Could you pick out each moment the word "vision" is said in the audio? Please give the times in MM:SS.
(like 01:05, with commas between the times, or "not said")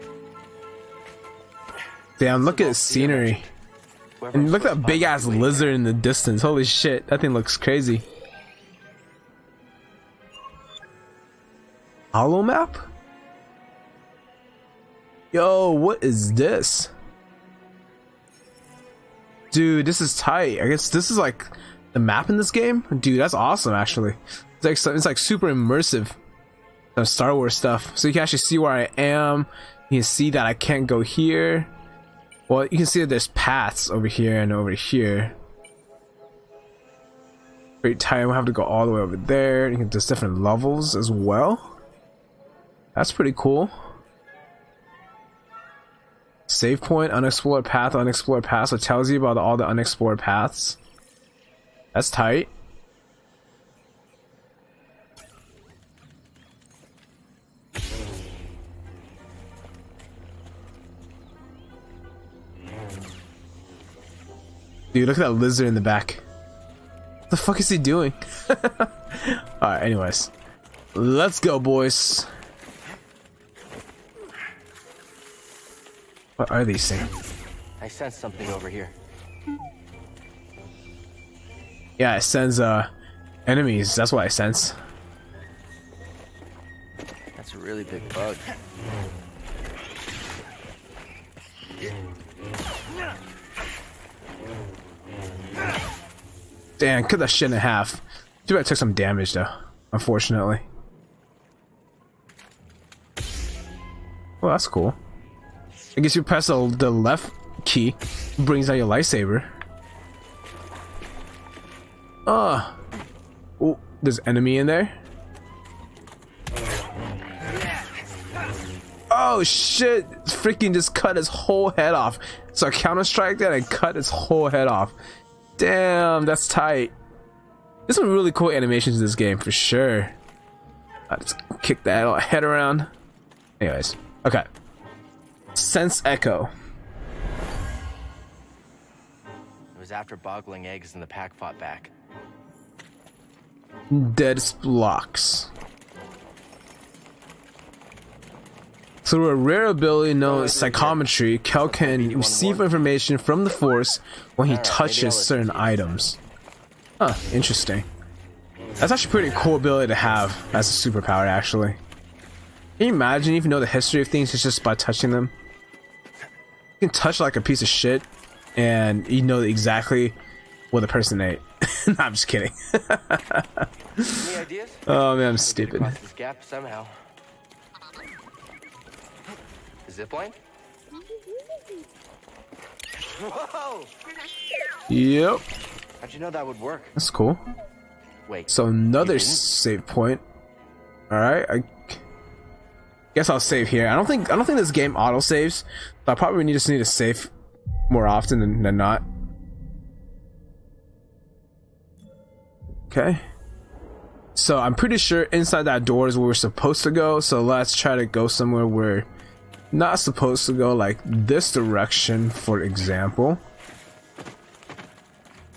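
not said.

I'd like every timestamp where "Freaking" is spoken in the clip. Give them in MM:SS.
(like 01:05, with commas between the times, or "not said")
02:00.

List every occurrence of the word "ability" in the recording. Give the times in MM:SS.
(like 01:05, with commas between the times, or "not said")
02:29, 02:39.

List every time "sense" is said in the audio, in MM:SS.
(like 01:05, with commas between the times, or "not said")
01:17, 01:24, 02:15.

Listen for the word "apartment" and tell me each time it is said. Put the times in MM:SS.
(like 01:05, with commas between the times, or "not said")
not said.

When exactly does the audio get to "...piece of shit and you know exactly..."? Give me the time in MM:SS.
02:47.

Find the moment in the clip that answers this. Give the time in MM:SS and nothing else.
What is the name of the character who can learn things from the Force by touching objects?
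02:31.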